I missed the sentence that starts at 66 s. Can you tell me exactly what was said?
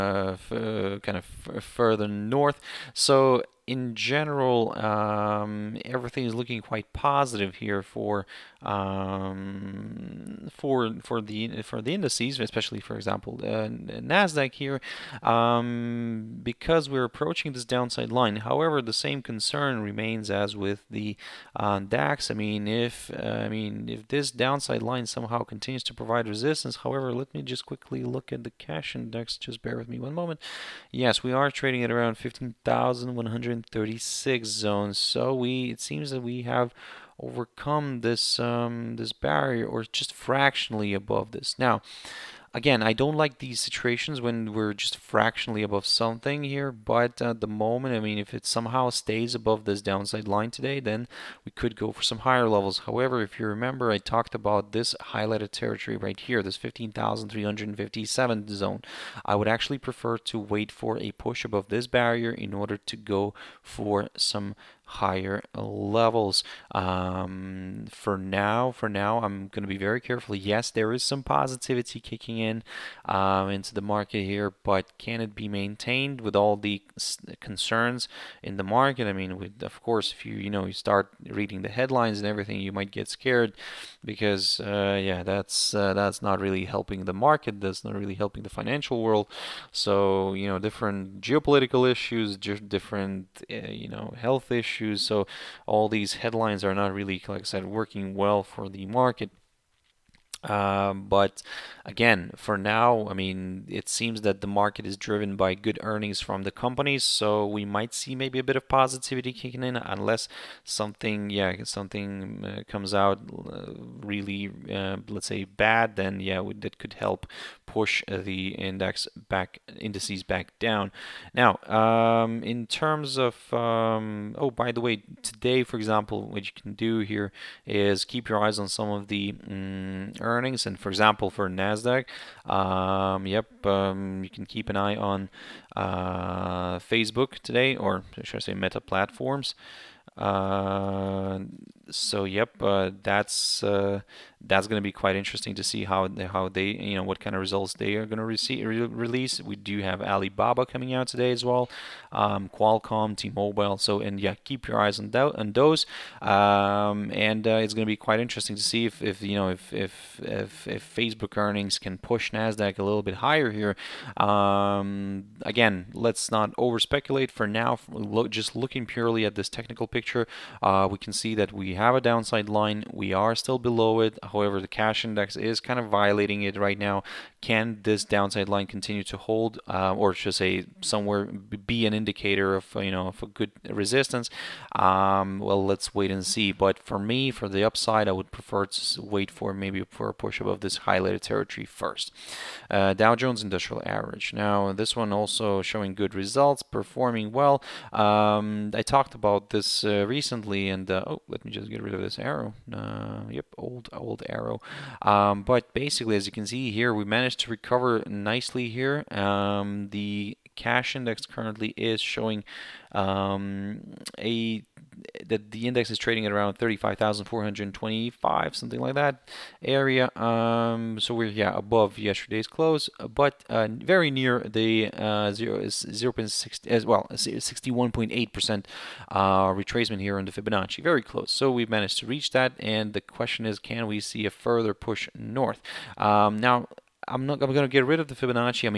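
Um, for now, for now, I'm going to be very careful.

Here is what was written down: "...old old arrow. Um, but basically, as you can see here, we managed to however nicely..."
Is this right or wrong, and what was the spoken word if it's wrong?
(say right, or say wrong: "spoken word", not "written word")
wrong: "recover", not "however".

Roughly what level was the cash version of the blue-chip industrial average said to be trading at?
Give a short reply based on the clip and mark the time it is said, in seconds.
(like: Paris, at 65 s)
35,425, at 216 s.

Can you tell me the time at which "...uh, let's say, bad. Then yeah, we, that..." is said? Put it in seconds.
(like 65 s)
114 s.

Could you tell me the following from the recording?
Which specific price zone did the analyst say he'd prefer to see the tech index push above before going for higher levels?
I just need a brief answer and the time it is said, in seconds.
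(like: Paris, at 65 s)
15,357, at 56 s.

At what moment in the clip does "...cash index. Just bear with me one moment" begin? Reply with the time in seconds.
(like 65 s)
28 s.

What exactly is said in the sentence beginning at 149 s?
We do have Alibaba coming out today as well, um, Qualcomm, T-Mobile.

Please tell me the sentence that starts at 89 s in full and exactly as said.
So you know, different geopolitical issues, different uh, you know health issues issues.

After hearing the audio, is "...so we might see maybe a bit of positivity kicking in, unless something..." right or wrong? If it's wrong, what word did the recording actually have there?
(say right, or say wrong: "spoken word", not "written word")
right.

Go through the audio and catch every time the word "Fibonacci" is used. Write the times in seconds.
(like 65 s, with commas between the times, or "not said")
230 s, 238 s.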